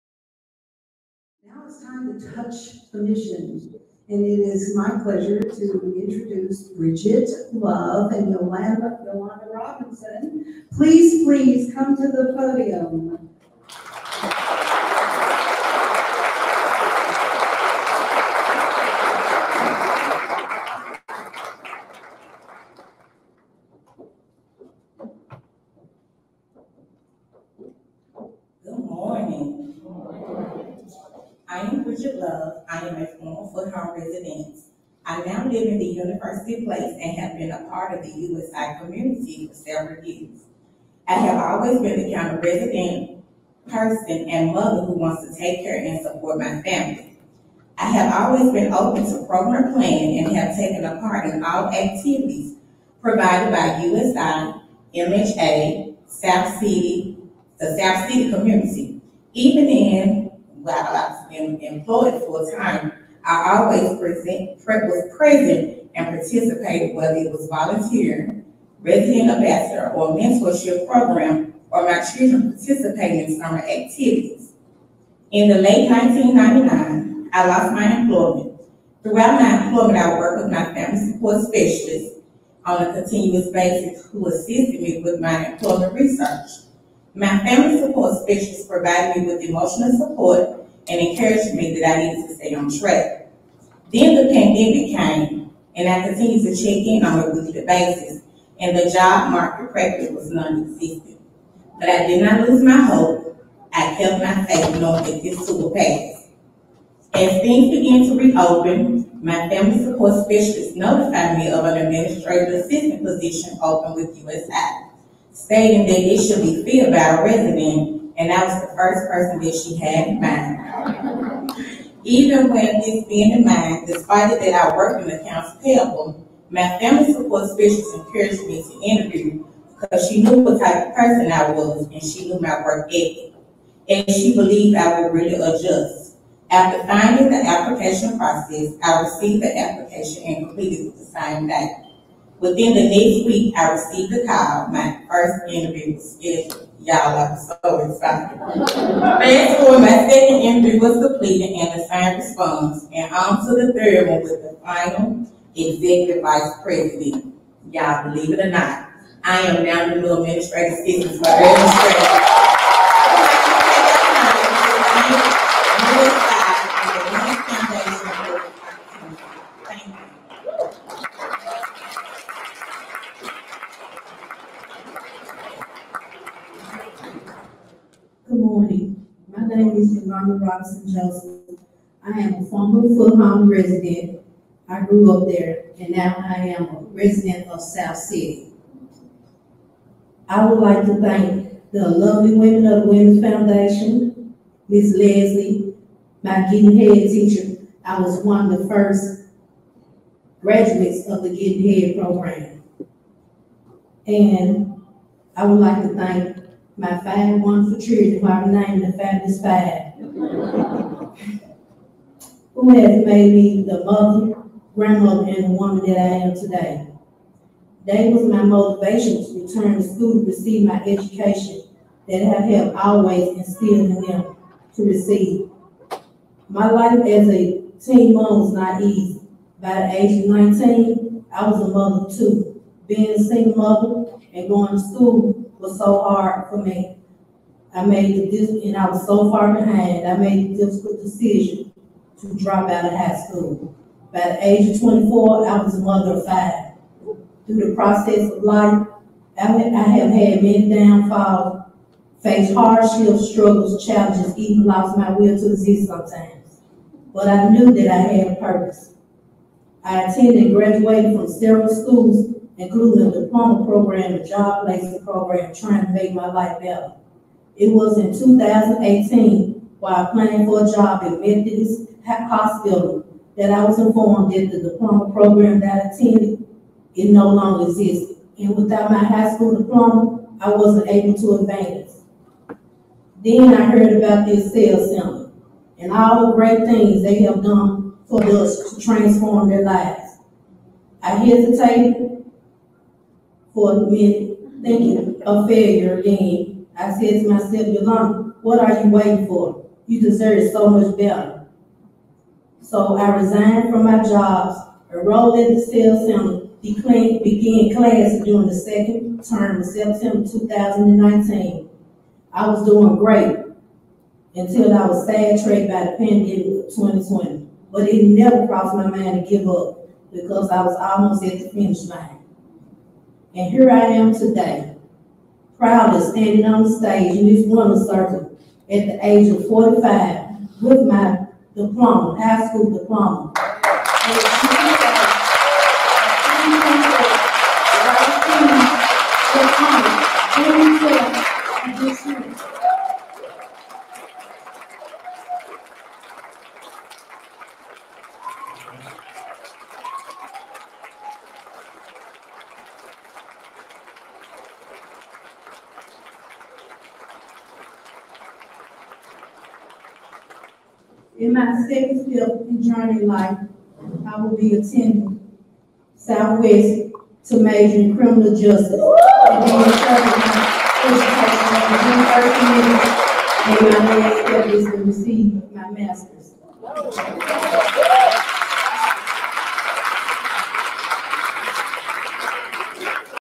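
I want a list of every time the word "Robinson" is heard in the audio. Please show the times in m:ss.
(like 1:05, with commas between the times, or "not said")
0:09, 3:00.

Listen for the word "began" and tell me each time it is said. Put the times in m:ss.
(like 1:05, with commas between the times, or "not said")
1:47, 5:06.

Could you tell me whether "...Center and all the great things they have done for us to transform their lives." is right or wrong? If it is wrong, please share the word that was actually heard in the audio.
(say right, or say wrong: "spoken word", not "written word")
right.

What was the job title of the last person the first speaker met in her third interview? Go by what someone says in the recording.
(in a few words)
Executive vice president.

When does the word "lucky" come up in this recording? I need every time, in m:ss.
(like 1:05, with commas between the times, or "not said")
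not said.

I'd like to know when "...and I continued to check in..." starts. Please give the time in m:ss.
1:35.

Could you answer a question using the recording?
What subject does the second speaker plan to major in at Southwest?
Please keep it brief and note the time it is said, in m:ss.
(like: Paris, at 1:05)
Criminal justice, at 6:07.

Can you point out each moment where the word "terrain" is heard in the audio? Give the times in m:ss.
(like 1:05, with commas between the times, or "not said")
not said.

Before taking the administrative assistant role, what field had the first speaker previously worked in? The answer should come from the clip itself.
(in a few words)
Accounts payable.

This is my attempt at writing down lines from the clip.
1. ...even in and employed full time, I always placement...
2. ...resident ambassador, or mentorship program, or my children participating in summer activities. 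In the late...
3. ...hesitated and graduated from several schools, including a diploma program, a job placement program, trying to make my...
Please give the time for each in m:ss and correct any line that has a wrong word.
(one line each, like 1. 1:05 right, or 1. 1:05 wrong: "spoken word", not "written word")
1. 0:59 wrong: "present", not "placement"
2. 1:08 right
3. 4:20 wrong: "attended", not "hesitated".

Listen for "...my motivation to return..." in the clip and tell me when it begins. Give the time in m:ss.
3:38.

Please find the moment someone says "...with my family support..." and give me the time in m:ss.
1:20.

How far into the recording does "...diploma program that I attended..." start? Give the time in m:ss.
4:34.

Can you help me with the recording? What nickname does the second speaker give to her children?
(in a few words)
The Fabulous Five.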